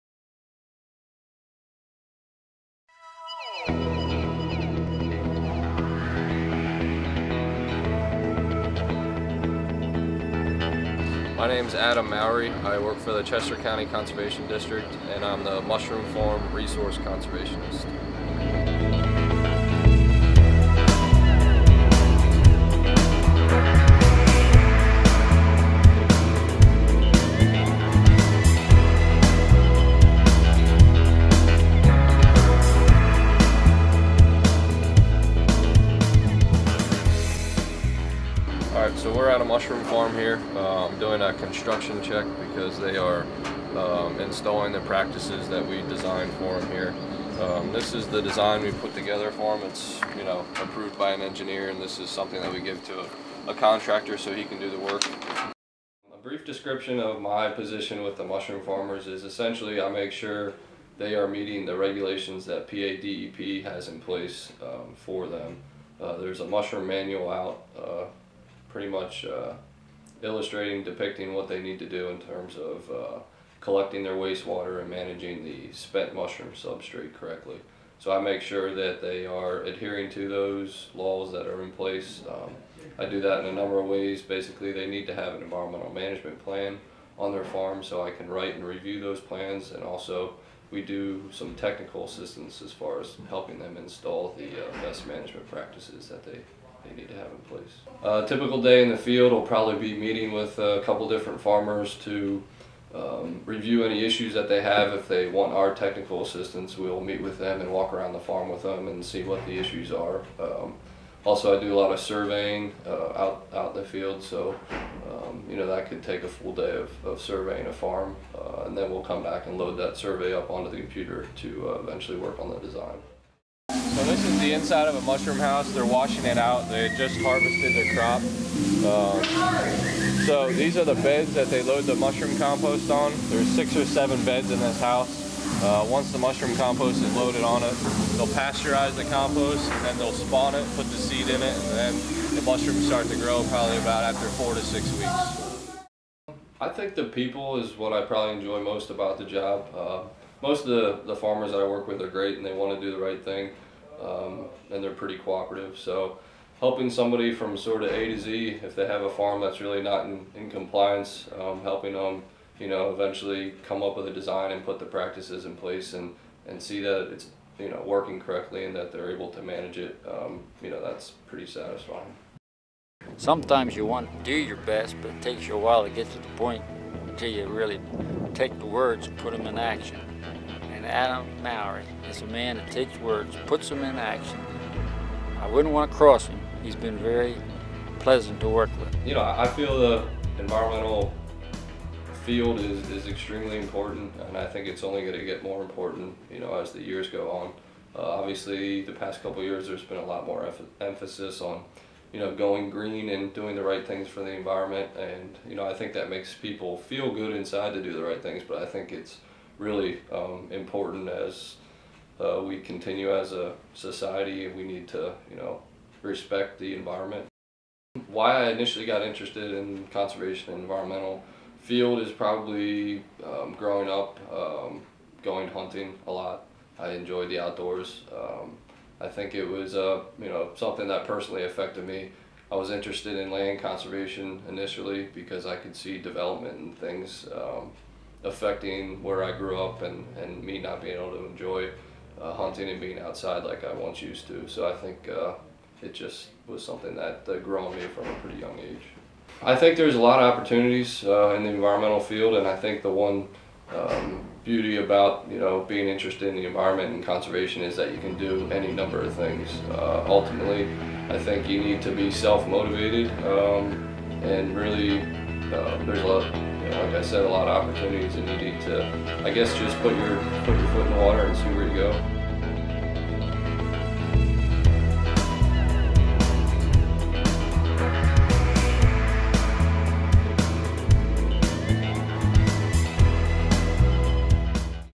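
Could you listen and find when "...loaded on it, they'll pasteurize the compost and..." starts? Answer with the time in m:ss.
2:17.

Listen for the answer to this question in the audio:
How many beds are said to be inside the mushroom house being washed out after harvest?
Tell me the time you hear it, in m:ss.
2:13.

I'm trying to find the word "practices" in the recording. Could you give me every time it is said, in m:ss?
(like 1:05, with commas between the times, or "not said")
0:44, 1:35, 2:44.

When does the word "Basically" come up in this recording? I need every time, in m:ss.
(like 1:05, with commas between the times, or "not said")
1:24.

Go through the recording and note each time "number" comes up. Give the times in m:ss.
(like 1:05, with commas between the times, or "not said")
1:23, 4:18.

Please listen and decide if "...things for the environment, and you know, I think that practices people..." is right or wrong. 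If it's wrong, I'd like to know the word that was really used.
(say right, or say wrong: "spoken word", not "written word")
wrong: "makes", not "practices".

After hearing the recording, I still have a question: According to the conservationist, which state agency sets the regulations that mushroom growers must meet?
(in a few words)
PADEP.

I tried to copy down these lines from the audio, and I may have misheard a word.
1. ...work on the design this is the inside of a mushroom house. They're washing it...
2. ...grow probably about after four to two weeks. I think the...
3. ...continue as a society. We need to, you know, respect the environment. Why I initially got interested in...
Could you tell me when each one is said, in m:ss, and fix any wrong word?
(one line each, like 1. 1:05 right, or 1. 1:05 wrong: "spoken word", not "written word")
1. 2:02 right
2. 2:23 wrong: "six", not "two"
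3. 3:32 right.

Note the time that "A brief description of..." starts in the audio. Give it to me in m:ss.
0:56.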